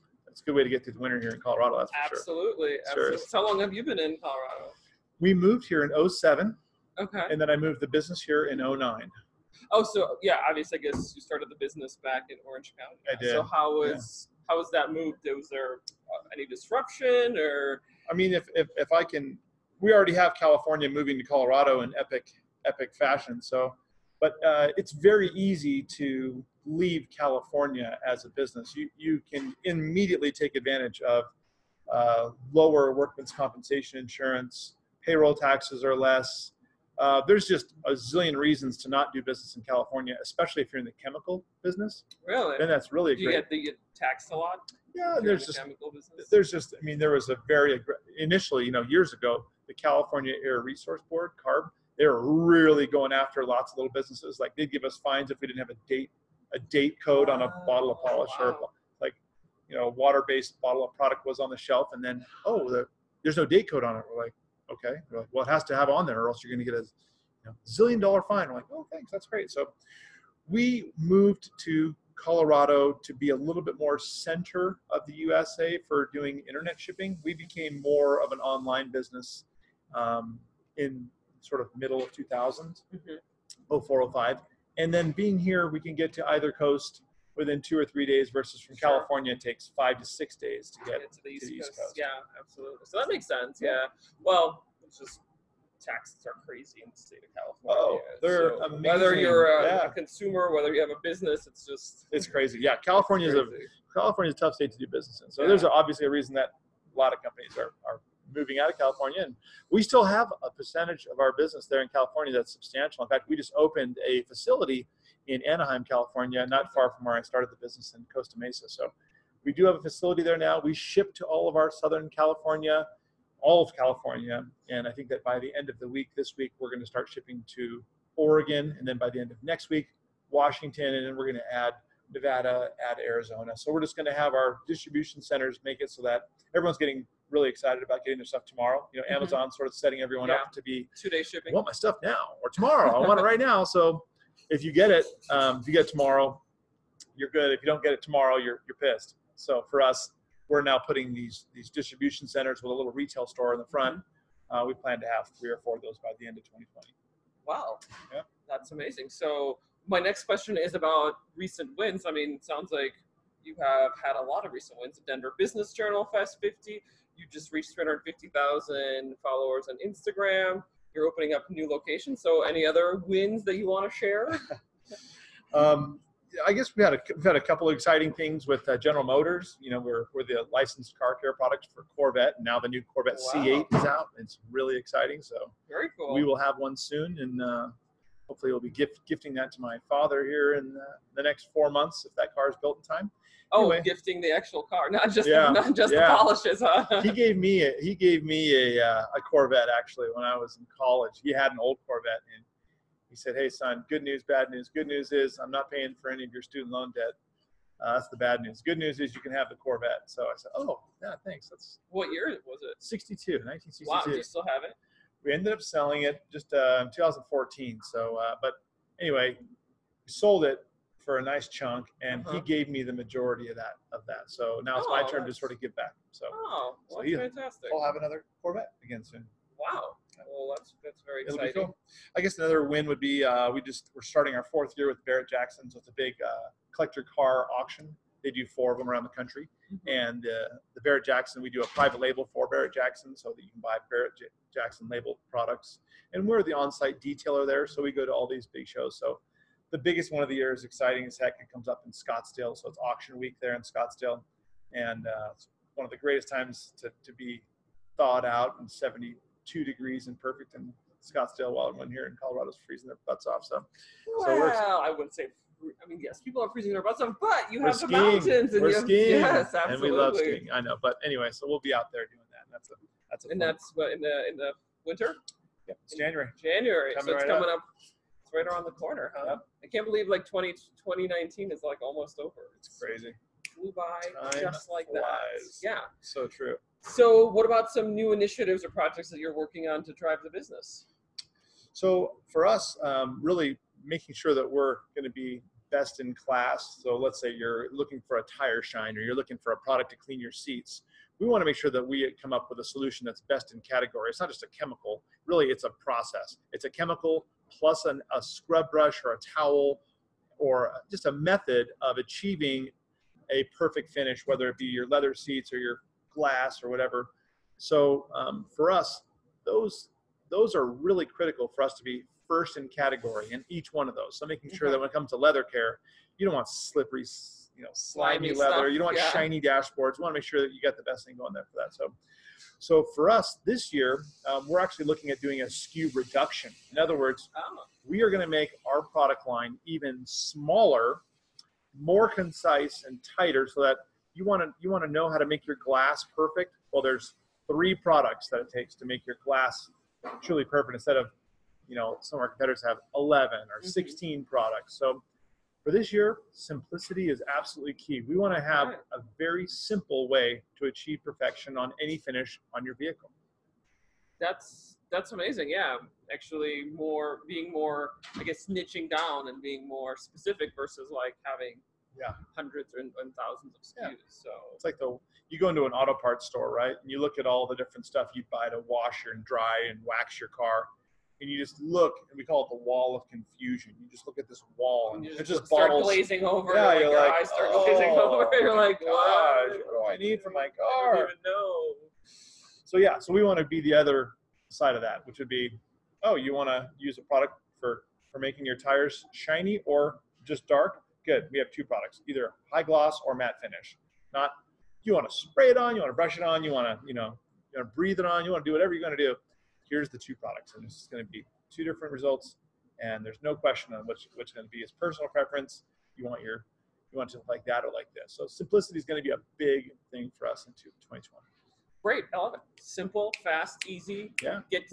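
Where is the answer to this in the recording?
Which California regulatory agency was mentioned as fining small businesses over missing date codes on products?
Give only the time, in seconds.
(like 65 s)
49 s.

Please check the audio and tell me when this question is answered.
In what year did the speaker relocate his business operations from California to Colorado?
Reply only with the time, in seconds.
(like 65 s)
8 s.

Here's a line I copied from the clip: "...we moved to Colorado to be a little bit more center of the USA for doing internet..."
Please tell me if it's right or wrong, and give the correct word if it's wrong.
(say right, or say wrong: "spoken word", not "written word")
right.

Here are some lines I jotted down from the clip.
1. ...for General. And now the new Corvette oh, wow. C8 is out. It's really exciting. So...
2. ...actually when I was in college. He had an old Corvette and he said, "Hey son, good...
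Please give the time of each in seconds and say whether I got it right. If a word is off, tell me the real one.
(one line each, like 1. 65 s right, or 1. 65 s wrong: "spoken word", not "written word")
1. 181 s wrong: "Corvette", not "General"
2. 199 s right.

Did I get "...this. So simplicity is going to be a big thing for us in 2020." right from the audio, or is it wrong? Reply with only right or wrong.
right.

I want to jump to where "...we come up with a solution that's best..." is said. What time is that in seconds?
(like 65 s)
301 s.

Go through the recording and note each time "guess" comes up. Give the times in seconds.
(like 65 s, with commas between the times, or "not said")
10 s, 176 s, 232 s, 368 s.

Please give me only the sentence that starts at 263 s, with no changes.
So, well, so I wouldn't say I mean, yes, people are freezing their butts off, but you we're have skiing.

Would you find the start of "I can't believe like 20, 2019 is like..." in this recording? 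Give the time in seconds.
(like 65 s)
279 s.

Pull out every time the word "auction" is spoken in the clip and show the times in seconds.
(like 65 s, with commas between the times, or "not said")
237 s, 252 s.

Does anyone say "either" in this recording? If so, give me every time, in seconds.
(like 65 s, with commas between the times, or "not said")
86 s, 402 s.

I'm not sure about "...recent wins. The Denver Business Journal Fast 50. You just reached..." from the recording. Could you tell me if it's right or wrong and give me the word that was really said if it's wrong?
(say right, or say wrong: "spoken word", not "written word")
right.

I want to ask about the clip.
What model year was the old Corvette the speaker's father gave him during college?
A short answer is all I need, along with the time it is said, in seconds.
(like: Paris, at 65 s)
1962, at 213 s.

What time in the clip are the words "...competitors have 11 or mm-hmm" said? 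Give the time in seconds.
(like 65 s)
352 s.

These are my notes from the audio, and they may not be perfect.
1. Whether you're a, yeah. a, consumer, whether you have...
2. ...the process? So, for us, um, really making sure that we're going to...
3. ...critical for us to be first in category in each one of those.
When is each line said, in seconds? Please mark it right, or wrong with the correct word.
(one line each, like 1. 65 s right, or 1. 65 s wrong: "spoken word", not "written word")
1. 98 s right
2. 290 s wrong: "business", not "process"
3. 321 s right.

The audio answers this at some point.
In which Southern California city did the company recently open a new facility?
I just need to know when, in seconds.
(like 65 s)
115 s.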